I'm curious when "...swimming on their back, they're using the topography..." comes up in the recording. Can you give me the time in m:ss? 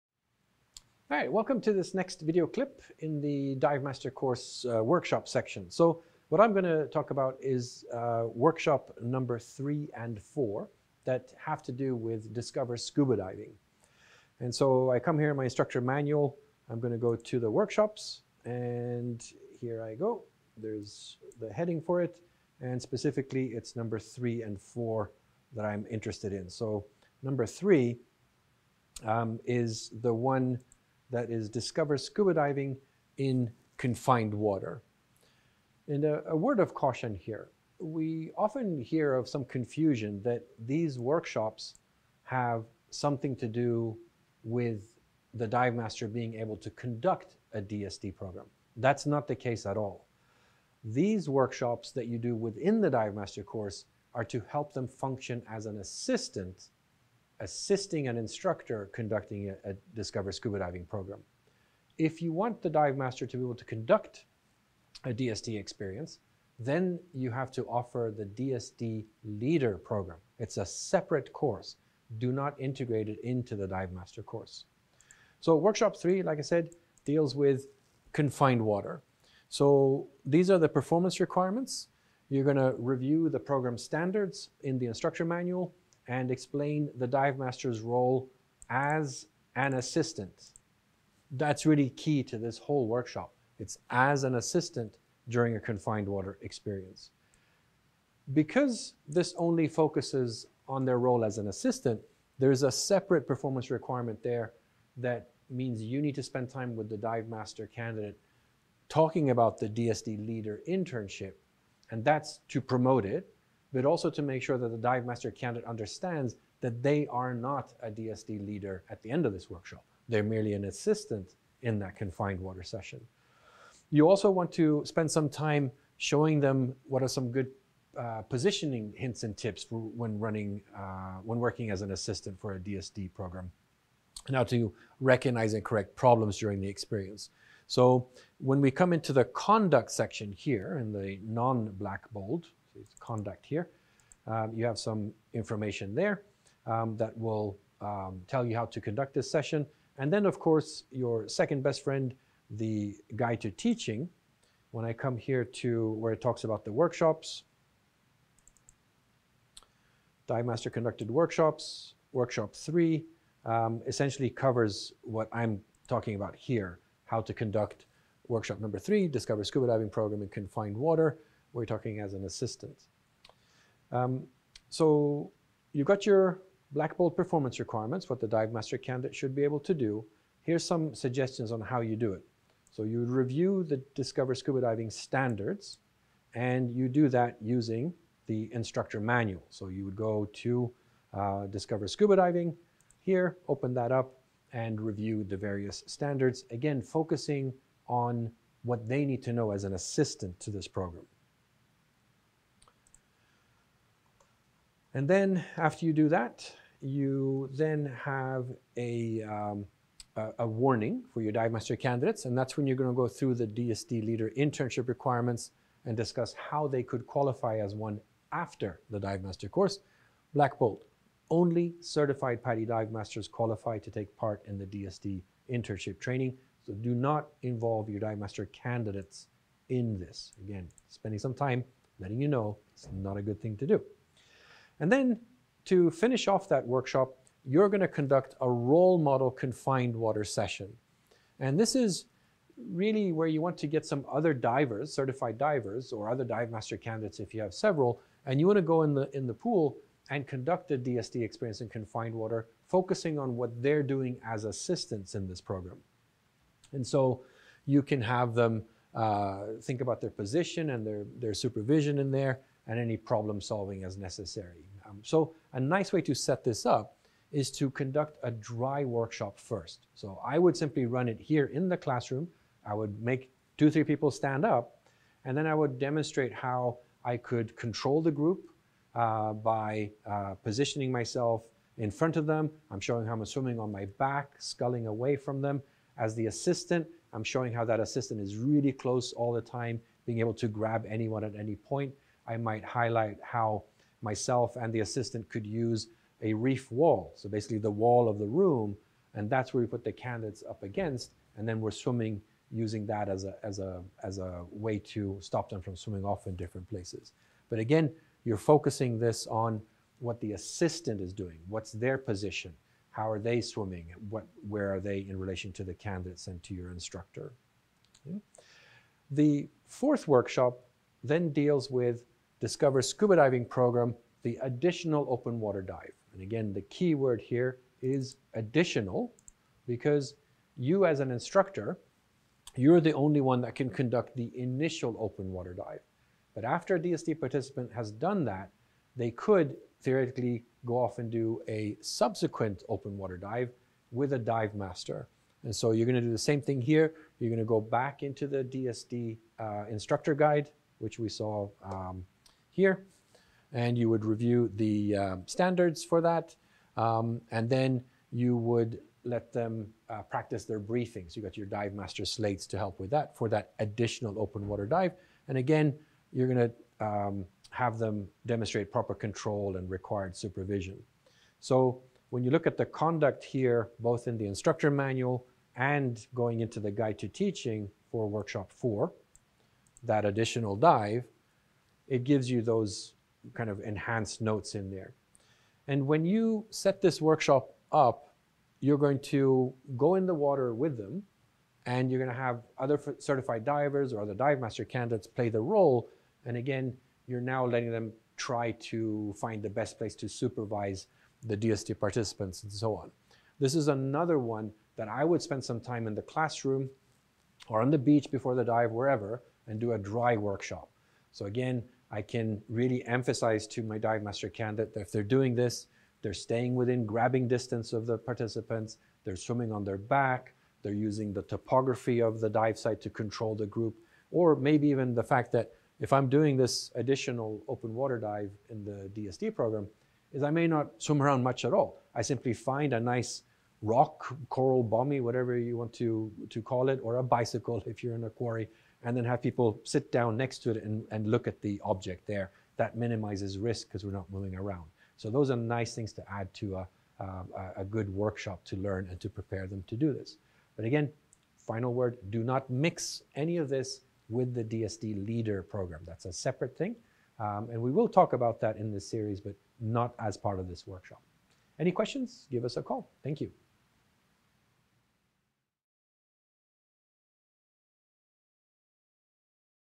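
6:59.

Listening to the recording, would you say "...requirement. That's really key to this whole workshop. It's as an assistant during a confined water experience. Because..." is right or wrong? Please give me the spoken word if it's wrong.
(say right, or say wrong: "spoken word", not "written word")
wrong: "assistant", not "requirement".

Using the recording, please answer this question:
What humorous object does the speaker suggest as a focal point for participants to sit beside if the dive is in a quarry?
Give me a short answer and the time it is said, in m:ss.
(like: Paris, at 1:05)
a bicycle, at 7:16.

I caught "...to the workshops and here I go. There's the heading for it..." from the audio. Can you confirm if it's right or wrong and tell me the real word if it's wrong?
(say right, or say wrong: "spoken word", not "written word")
right.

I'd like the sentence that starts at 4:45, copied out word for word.
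As the assistant, I'm showing how that assistant is really close all the time, being able to grab anyone at any point.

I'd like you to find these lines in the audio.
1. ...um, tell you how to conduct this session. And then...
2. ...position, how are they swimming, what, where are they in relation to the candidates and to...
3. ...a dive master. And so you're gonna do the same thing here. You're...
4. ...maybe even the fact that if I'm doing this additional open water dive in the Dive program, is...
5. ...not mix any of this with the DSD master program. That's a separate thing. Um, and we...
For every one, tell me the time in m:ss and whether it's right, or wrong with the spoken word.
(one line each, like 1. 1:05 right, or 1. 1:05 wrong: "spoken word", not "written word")
1. 2:27 right
2. 5:11 right
3. 5:44 right
4. 7:04 wrong: "DSD", not "Dive"
5. 7:32 wrong: "leader", not "master".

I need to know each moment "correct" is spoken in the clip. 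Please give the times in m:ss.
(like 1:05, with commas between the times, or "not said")
2:15.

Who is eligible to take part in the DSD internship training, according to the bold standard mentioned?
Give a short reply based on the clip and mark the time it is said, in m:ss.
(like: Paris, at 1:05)
certified PADI dive masters, at 3:41.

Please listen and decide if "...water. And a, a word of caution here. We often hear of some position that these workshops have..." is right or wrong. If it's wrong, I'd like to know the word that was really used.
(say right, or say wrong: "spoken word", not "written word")
wrong: "confusion", not "position".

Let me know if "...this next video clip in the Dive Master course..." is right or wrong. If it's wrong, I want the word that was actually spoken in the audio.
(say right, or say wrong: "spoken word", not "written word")
right.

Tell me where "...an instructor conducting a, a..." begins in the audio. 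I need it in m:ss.
0:58.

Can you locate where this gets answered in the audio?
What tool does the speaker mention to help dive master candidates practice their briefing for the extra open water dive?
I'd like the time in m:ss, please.
6:01.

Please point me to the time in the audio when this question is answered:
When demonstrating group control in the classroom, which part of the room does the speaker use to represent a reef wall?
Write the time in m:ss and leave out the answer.
4:57.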